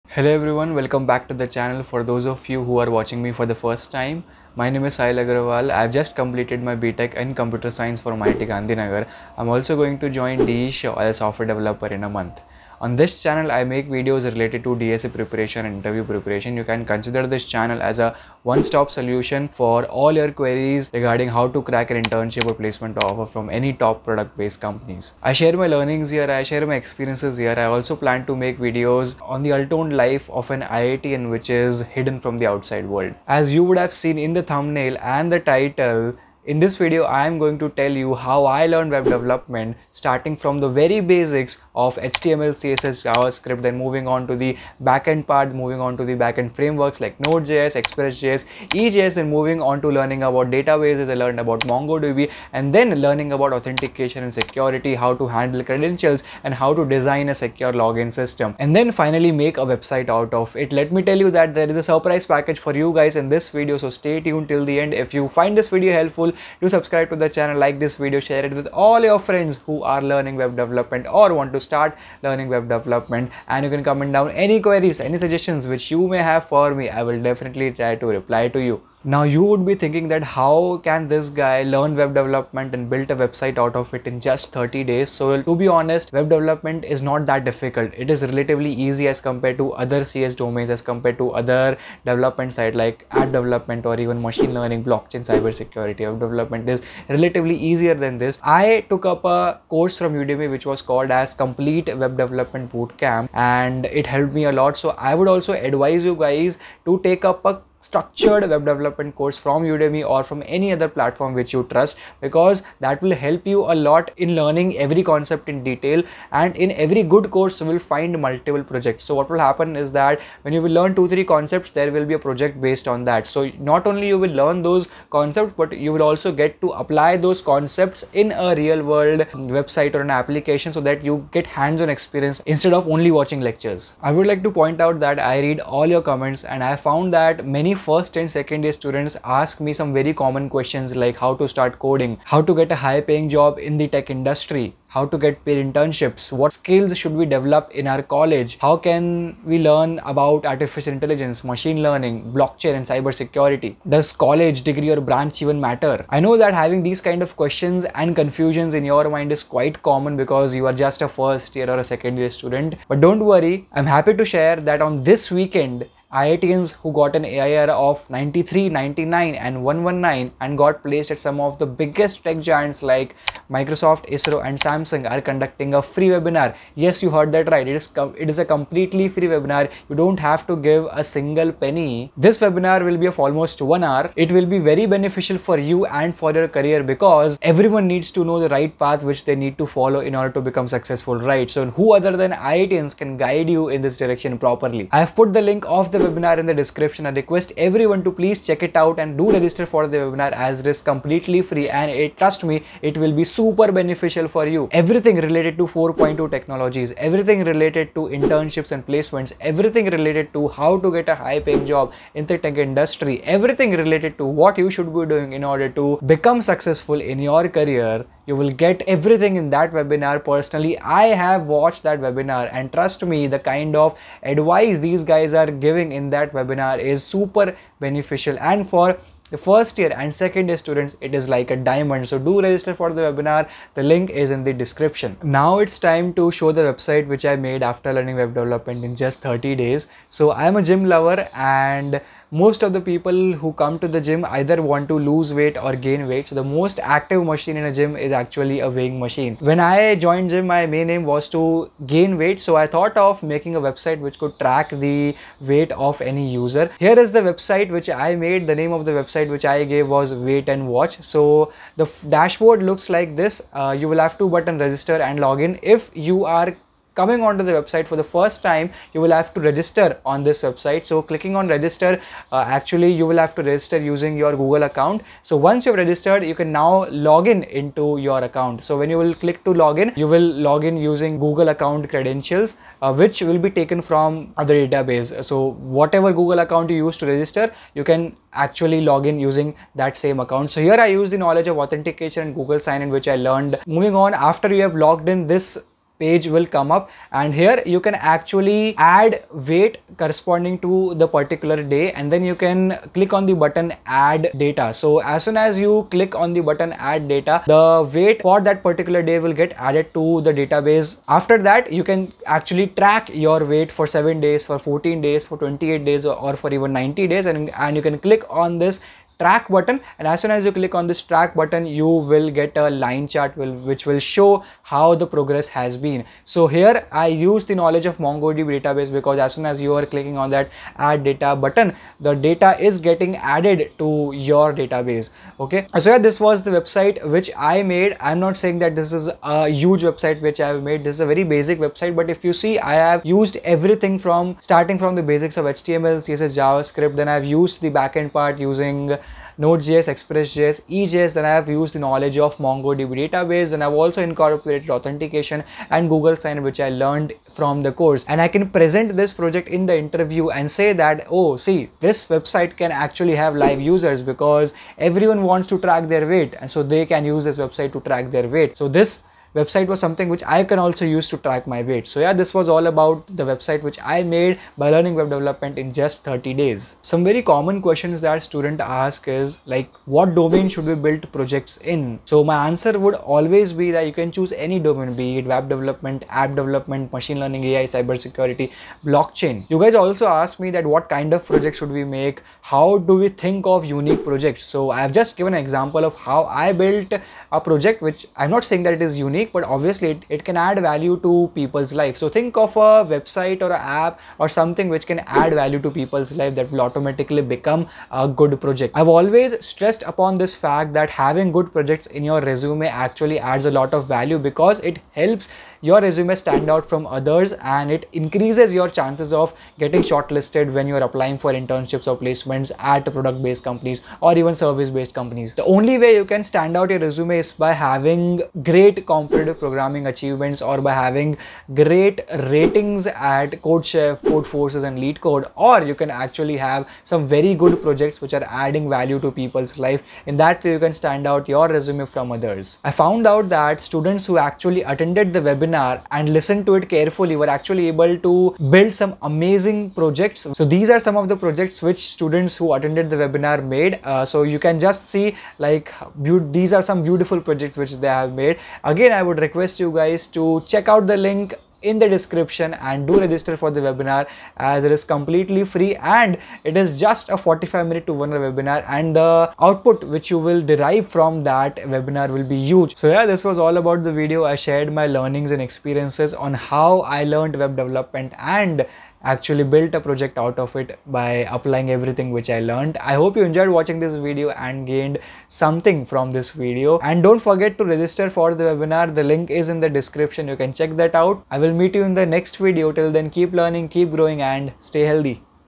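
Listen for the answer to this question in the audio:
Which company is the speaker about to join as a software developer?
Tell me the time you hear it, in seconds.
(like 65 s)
10 s.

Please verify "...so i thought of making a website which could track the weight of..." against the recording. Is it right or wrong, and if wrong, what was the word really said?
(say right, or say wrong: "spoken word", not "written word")
right.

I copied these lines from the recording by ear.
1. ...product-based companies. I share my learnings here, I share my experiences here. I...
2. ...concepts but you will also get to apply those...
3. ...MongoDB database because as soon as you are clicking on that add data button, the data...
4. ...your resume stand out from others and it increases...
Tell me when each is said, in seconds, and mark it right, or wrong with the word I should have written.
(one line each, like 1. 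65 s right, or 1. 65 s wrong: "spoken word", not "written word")
1. 24 s right
2. 125 s right
3. 328 s right
4. 415 s right.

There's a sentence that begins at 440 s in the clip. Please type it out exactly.
In that way you can stand out your resume from others.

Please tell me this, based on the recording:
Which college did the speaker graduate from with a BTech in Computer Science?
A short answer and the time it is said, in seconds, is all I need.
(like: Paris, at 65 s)
IIT Gandhinagar, at 8 s.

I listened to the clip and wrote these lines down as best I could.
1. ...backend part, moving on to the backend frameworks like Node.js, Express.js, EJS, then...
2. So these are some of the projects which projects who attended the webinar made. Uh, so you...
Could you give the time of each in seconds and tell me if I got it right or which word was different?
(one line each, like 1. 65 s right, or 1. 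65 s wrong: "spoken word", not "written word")
1. 44 s right
2. 450 s wrong: "students", not "projects".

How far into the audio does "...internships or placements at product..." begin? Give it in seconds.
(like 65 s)
421 s.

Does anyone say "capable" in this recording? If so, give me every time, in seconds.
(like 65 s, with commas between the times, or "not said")
not said.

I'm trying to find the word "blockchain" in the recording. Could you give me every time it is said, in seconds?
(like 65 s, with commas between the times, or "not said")
94 s, 152 s, 388 s.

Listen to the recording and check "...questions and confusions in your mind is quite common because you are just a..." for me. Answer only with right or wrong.
right.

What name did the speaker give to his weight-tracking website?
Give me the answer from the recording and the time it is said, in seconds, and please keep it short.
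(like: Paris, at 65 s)
Weight and Watch, at 260 s.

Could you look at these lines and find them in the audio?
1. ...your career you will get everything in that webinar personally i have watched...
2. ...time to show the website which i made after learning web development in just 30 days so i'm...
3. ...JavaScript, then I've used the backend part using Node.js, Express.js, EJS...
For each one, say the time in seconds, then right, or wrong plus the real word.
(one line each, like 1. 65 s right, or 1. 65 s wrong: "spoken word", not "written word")
1. 217 s right
2. 235 s right
3. 346 s right.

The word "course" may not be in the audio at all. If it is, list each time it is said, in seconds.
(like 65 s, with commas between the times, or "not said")
99 s, 109 s, 117 s, 357 s.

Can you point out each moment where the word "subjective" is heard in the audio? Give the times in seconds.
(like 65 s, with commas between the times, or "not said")
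not said.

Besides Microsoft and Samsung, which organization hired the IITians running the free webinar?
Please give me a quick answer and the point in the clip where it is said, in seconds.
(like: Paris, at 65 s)
ISRO, at 174 s.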